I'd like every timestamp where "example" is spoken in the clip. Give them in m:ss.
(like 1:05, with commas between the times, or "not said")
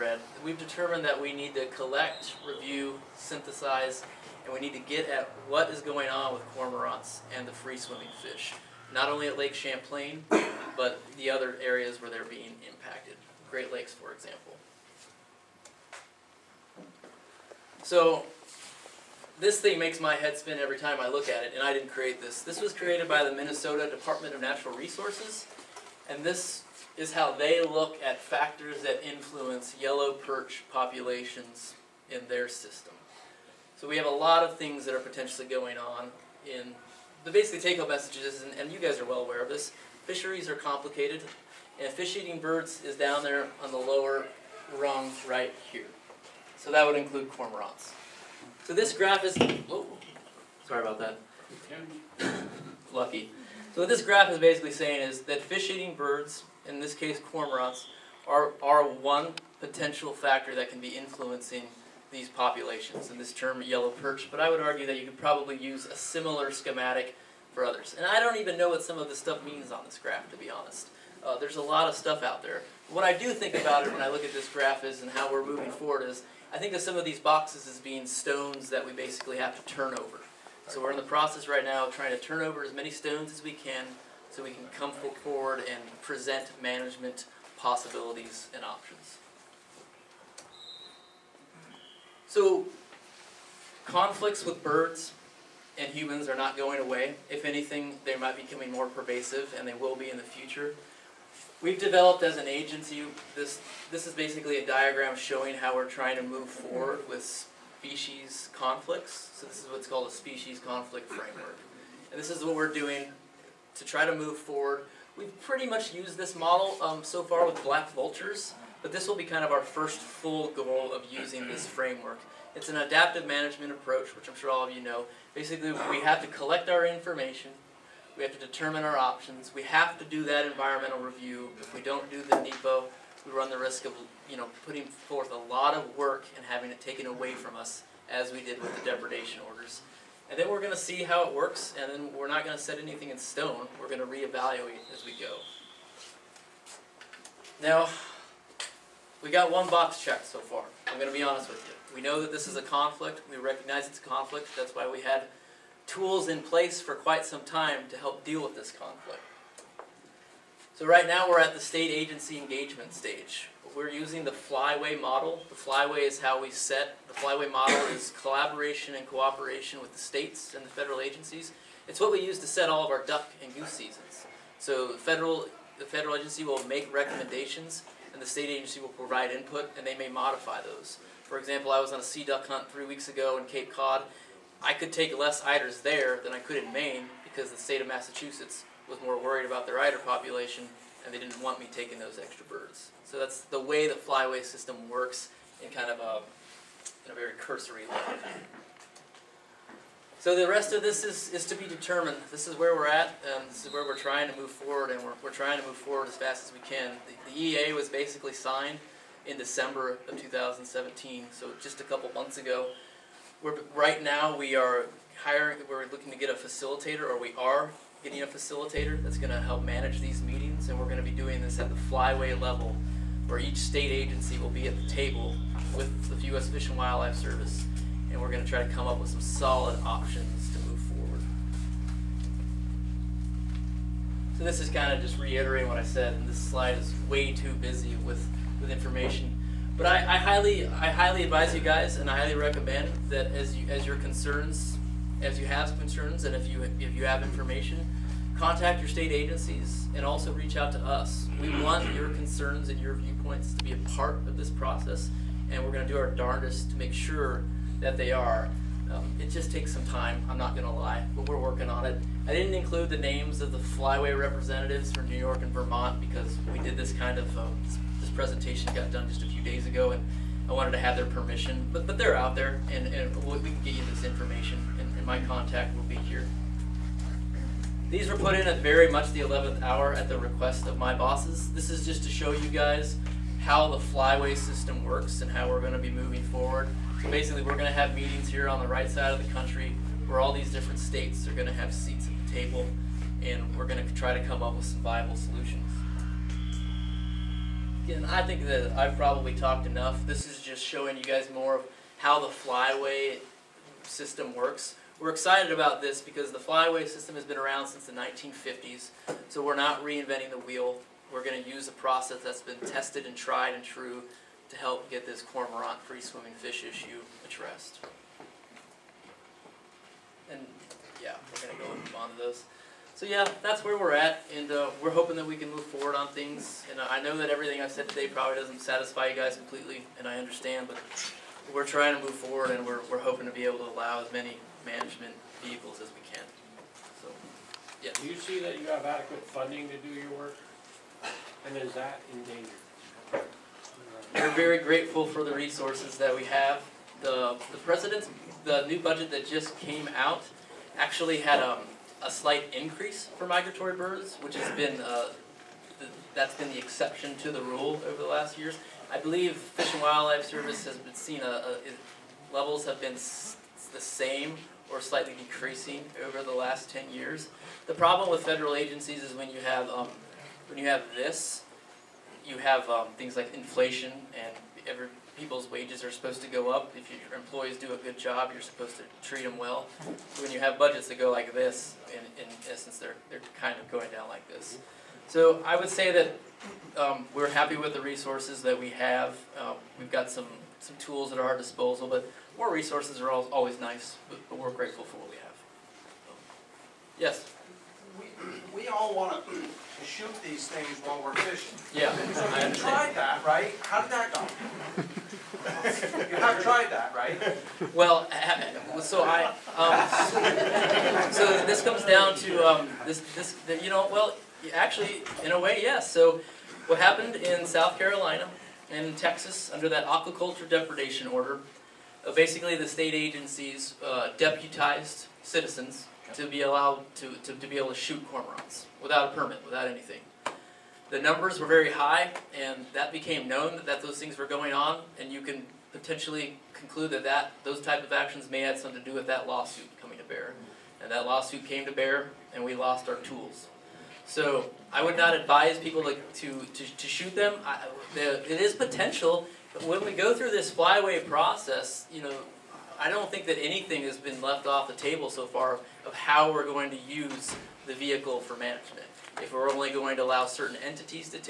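0:14, 3:01.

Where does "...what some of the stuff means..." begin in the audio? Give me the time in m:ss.
1:08.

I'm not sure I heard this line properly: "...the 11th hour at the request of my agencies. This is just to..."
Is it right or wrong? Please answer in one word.
wrong.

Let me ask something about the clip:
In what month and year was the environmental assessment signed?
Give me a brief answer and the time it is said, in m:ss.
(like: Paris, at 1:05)
December 2017, at 3:29.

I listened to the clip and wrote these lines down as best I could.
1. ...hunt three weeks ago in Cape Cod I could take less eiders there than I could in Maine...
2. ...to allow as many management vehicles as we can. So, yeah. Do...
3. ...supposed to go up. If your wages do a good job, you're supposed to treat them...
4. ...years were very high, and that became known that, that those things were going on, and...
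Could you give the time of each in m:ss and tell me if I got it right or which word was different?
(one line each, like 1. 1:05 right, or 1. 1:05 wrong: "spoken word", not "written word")
1. 3:02 right
2. 5:33 right
3. 6:15 wrong: "employees", not "wages"
4. 7:10 wrong: "numbers", not "years".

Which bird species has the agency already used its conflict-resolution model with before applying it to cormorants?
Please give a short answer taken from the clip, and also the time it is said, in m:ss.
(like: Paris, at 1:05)
black vultures, at 1:57.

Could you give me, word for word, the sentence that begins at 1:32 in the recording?
So conflicts with birds and humans are not going away.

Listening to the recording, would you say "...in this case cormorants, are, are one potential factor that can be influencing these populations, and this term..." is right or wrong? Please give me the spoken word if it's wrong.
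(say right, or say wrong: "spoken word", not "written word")
right.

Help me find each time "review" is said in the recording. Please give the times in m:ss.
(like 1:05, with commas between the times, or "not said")
0:02, 2:10.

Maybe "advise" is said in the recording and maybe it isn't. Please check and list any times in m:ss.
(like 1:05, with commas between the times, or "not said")
4:01, 7:25.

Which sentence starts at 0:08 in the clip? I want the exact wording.
Not only at Lake Champlain, but the other areas where they're being impacted.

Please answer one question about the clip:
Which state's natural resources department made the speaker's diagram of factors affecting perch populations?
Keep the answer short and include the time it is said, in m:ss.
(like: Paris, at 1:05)
Minnesota, at 0:23.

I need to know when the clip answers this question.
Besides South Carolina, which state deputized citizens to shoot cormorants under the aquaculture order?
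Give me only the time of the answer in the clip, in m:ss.
6:58.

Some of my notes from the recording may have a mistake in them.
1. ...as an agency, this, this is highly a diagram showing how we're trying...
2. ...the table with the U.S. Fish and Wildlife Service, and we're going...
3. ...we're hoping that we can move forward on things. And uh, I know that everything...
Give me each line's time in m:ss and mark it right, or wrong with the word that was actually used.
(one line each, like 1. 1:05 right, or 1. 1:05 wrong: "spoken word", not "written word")
1. 1:42 wrong: "basically", not "highly"
2. 3:44 right
3. 5:24 right.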